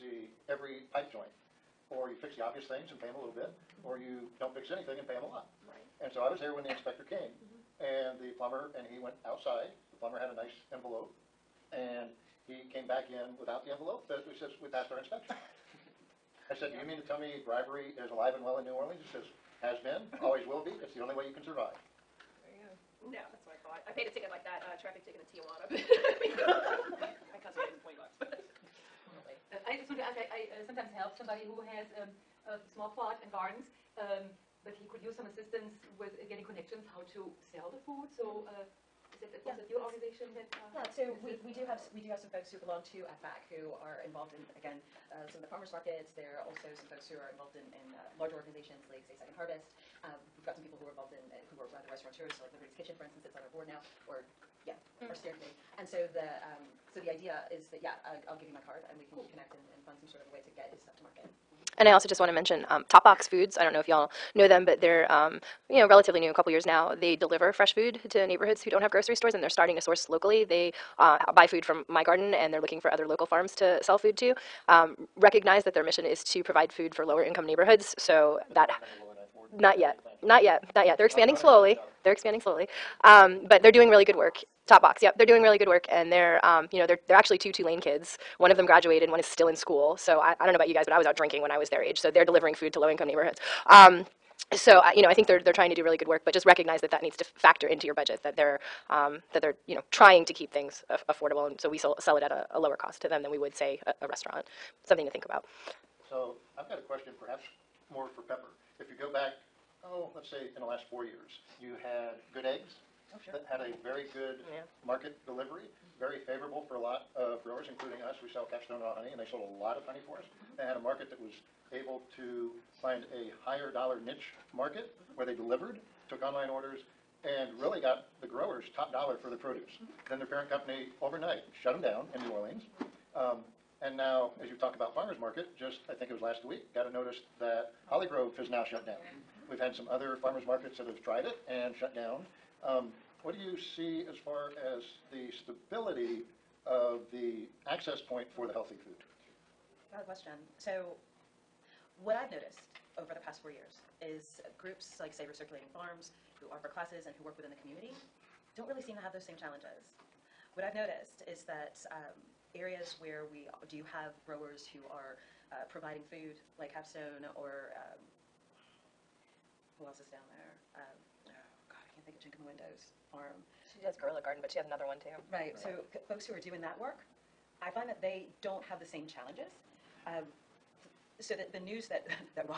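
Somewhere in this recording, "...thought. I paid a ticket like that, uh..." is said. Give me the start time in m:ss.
0:23.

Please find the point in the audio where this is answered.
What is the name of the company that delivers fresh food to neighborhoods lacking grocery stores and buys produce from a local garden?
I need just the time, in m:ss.
1:02.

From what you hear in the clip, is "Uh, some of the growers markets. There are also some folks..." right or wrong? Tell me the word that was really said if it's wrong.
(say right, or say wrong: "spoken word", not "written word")
wrong: "farmers", not "growers".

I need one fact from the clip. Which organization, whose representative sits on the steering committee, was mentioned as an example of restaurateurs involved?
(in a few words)
Liberty's Kitchen.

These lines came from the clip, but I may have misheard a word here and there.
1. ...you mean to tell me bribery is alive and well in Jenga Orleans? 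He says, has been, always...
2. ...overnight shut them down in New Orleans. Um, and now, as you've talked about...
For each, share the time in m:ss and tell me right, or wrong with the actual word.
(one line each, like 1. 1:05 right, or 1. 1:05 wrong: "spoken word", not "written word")
1. 0:16 wrong: "New", not "Jenga"
2. 2:11 right.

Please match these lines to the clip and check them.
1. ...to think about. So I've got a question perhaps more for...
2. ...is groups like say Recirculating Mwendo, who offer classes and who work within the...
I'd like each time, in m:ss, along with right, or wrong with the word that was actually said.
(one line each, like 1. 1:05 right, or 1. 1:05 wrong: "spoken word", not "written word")
1. 1:45 right
2. 2:34 wrong: "Farms", not "Mwendo".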